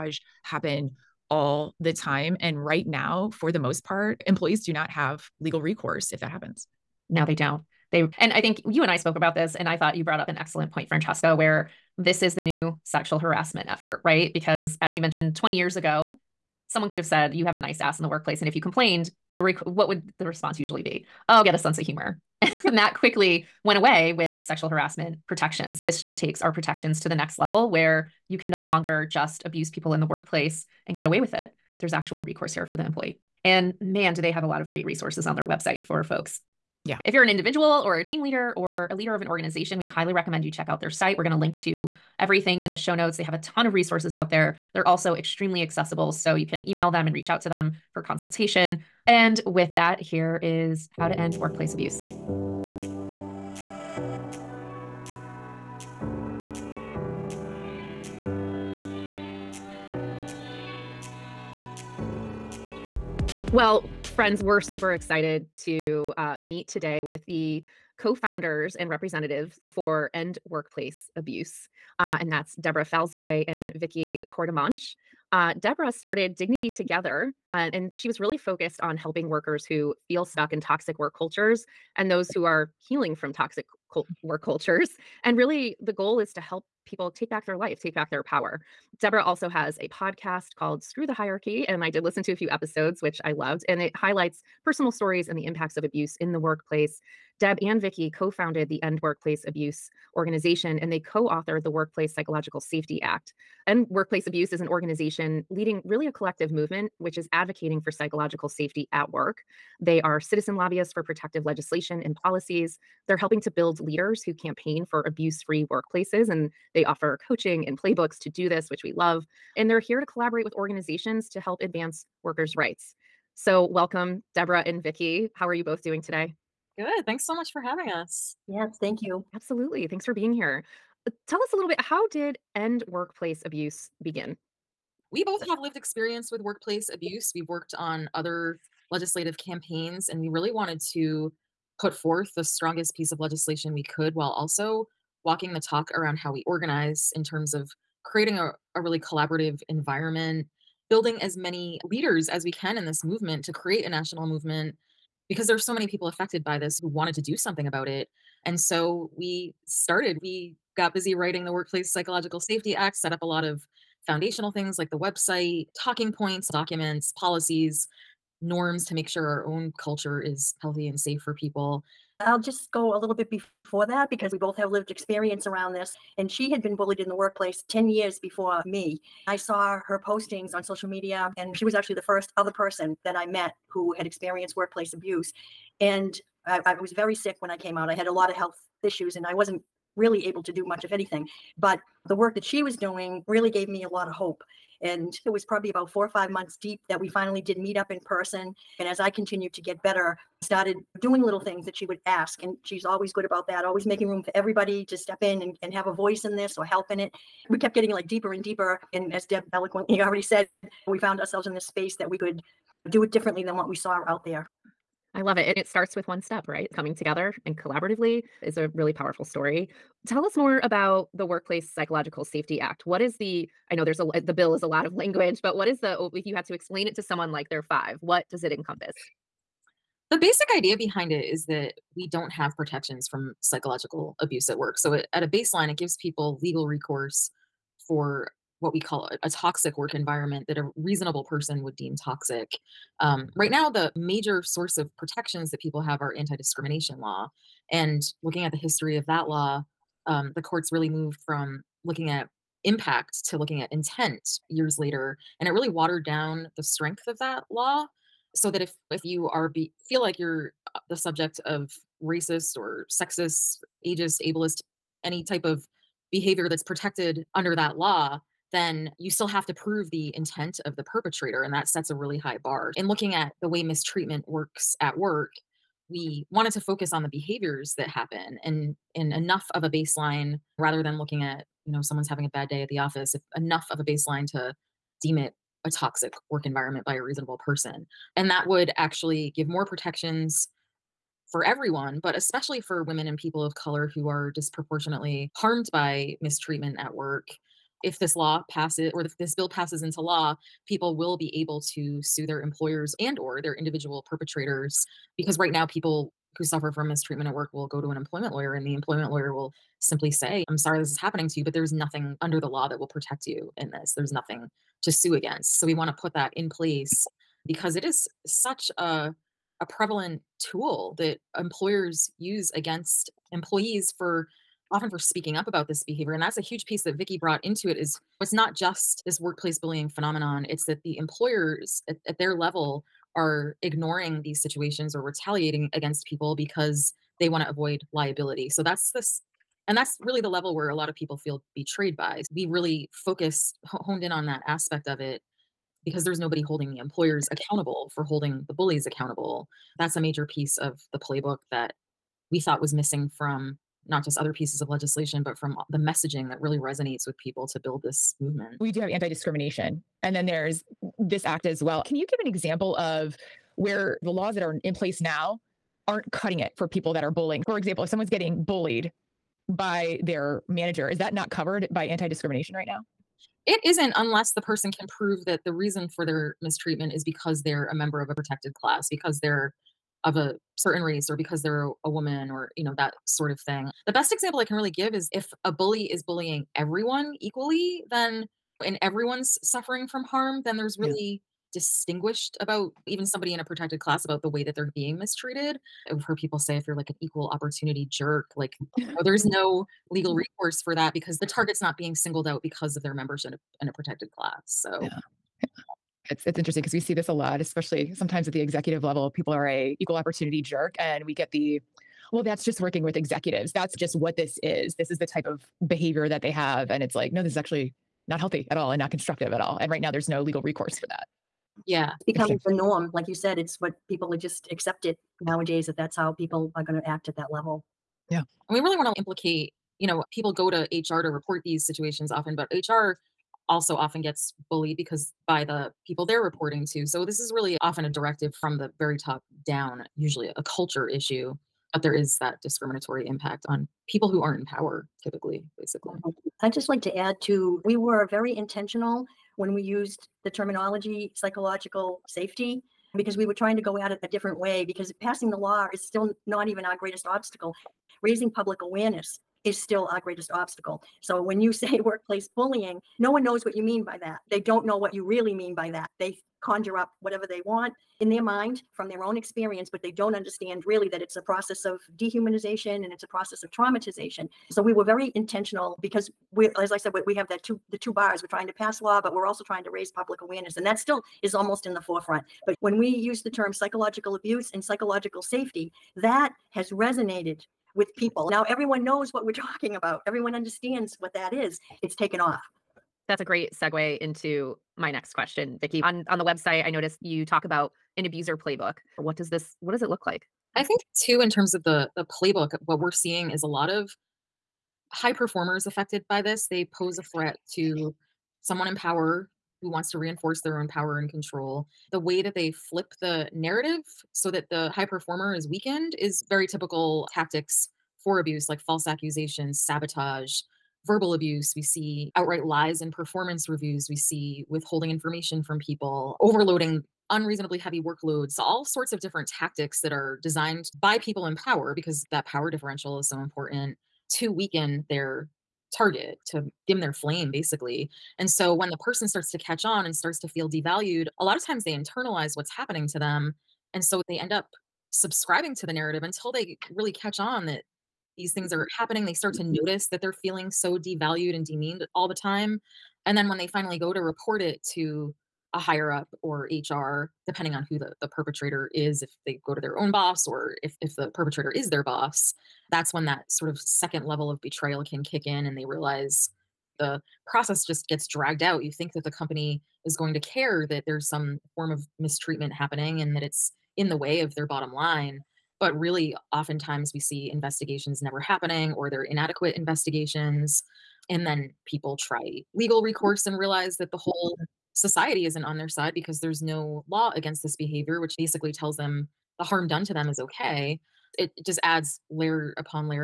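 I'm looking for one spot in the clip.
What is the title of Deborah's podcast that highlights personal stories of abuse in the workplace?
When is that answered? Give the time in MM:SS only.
01:30.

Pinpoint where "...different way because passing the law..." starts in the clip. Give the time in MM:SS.
07:34.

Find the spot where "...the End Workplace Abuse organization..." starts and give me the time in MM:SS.
01:38.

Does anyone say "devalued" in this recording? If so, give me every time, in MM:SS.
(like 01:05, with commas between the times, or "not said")
09:00, 09:10.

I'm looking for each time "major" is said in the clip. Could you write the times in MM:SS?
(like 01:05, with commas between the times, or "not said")
04:03, 05:49.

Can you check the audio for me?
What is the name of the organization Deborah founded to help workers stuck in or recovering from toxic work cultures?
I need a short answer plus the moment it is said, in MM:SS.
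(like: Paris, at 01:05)
Dignity Together, at 01:16.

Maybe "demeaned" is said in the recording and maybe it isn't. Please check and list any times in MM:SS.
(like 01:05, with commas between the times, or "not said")
09:11.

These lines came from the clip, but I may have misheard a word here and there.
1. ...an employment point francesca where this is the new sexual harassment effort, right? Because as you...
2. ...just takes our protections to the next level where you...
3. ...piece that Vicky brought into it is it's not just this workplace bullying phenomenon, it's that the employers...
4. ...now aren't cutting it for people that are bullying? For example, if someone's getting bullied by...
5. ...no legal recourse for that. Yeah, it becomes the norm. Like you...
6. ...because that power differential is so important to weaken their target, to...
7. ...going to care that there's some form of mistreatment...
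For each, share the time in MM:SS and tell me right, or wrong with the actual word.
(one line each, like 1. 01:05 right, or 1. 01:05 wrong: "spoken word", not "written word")
1. 00:10 wrong: "excellent", not "employment"
2. 00:26 right
3. 05:26 right
4. 06:05 right
5. 07:00 right
6. 08:51 right
7. 09:29 right.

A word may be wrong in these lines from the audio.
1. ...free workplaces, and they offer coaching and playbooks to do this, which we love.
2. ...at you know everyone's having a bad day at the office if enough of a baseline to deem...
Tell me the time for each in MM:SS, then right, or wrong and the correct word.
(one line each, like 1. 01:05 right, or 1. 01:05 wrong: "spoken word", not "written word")
1. 01:55 right
2. 04:41 wrong: "someone", not "everyone".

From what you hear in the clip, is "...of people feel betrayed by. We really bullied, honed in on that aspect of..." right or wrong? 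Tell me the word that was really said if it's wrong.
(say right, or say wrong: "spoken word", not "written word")
wrong: "focused", not "bullied".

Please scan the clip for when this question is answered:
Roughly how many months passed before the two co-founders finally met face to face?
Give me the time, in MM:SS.
03:15.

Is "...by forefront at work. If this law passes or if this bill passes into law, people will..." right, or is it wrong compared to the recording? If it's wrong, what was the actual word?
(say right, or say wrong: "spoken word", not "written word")
wrong: "mistreatment", not "forefront".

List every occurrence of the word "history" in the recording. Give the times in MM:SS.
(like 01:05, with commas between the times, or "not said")
04:08.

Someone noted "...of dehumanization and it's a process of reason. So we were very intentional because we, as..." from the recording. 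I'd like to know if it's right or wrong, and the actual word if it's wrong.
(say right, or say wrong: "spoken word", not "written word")
wrong: "traumatization", not "reason".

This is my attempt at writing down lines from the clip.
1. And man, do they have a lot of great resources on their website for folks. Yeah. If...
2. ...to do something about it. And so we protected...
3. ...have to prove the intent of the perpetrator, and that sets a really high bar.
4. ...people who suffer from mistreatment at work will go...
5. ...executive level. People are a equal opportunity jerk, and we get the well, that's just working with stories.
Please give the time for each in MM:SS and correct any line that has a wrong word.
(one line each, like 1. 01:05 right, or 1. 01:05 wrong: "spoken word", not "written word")
1. 00:33 right
2. 02:37 wrong: "started", not "protected"
3. 04:29 right
4. 05:05 right
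5. 06:48 wrong: "executives", not "stories".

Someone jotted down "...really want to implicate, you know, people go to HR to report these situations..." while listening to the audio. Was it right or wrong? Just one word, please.
right.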